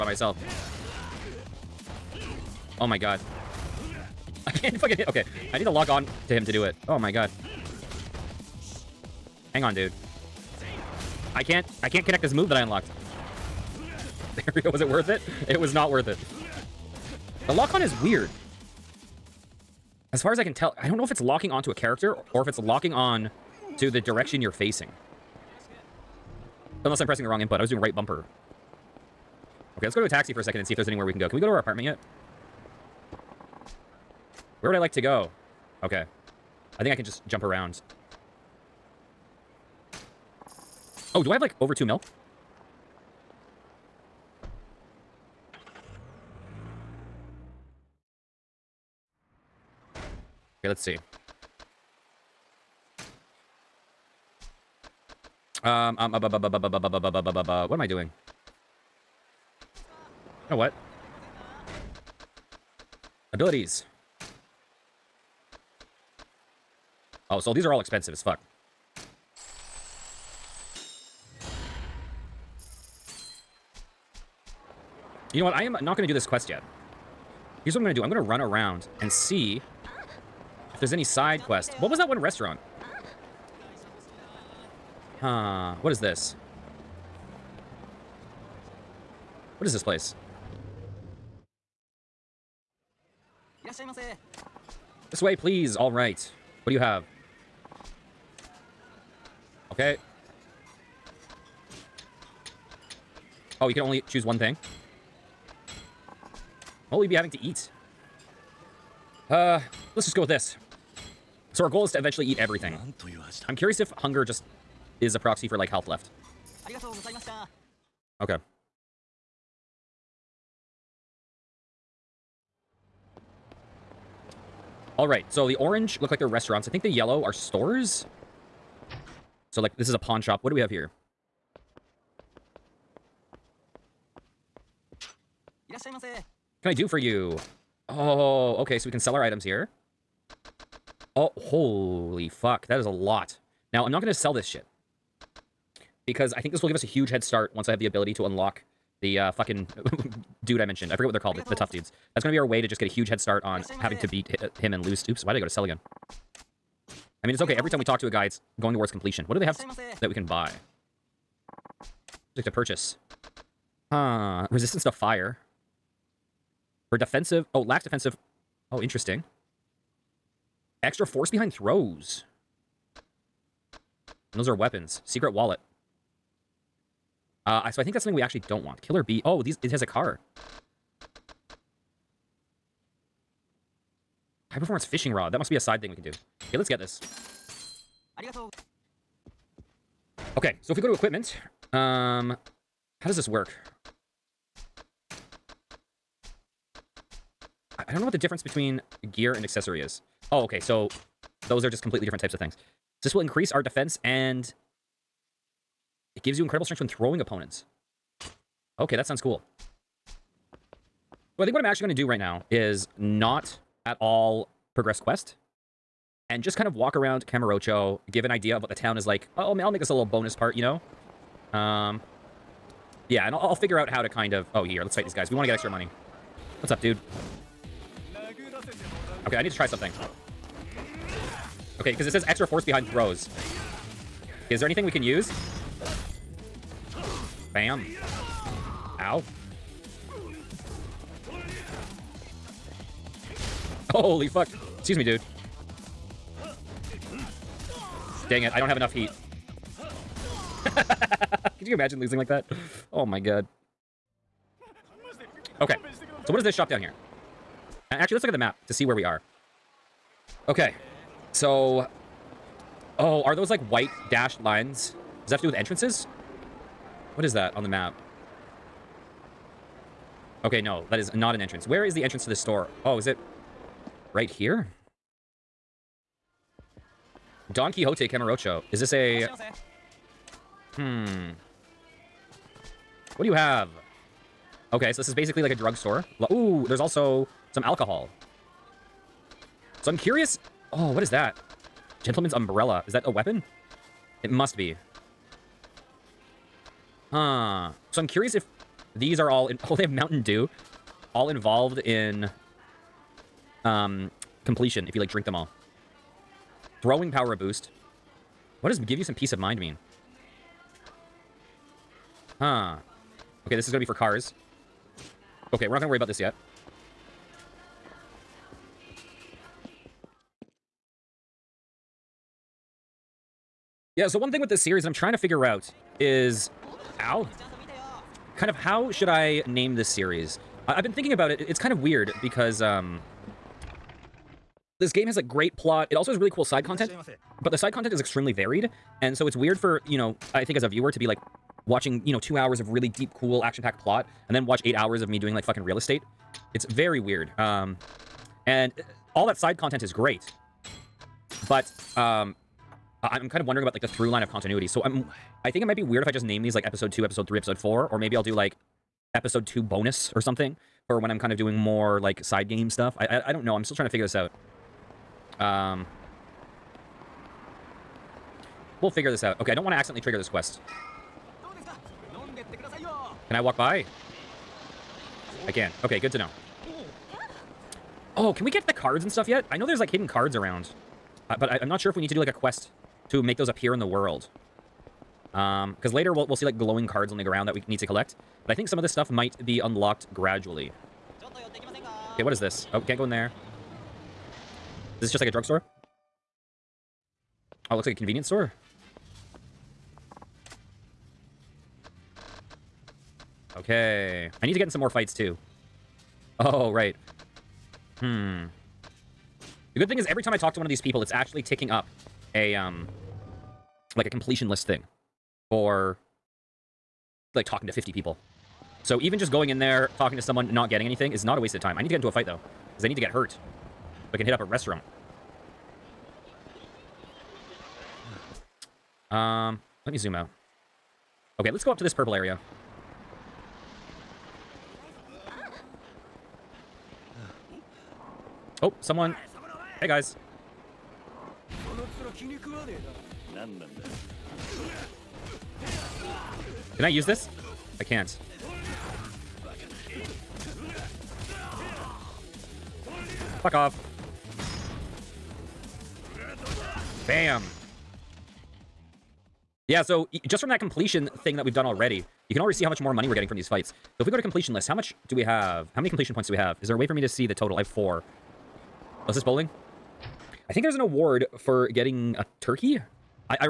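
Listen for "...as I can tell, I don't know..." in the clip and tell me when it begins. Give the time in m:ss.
0:20.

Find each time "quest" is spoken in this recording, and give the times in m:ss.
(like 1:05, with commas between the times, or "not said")
1:16, 1:21, 3:34, 6:10, 6:22.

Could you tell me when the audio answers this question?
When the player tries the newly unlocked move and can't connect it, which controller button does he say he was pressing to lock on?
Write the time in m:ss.
0:27.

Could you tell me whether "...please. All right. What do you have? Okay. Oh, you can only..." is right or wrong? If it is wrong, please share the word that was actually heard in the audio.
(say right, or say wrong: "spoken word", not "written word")
right.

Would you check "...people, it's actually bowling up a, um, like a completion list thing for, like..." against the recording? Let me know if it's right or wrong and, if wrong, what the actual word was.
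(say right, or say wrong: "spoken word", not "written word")
wrong: "ticking", not "bowling".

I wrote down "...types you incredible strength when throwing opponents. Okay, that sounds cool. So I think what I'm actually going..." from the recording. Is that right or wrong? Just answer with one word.
wrong.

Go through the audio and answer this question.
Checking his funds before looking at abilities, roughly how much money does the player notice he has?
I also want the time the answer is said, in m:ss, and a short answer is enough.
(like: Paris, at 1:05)
Over two mil, at 0:41.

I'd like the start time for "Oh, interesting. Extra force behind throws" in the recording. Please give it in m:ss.
2:48.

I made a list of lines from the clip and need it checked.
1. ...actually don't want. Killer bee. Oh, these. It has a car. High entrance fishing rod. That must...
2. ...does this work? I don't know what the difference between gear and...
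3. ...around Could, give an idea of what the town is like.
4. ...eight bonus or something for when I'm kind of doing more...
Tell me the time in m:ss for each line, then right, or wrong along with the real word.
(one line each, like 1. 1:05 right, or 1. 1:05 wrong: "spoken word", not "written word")
1. 2:58 wrong: "performance", not "entrance"
2. 3:13 right
3. 3:36 wrong: "Kamurocho", not "Could"
4. 5:59 wrong: "two", not "eight".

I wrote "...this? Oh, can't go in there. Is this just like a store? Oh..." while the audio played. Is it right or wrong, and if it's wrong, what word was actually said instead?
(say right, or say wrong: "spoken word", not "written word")
wrong: "drugstore", not "store".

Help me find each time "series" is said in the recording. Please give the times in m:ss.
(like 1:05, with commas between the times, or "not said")
5:24, 5:29.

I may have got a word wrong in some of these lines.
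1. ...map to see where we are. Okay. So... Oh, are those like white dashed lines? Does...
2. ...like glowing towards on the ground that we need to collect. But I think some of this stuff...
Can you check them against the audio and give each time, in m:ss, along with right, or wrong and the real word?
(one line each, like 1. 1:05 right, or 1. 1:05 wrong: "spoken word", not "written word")
1. 4:18 right
2. 6:26 wrong: "cards", not "towards".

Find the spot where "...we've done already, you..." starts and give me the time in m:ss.
7:41.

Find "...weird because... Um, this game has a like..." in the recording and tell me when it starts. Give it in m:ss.
5:31.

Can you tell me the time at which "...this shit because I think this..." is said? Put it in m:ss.
2:24.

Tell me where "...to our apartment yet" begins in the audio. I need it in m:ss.
0:31.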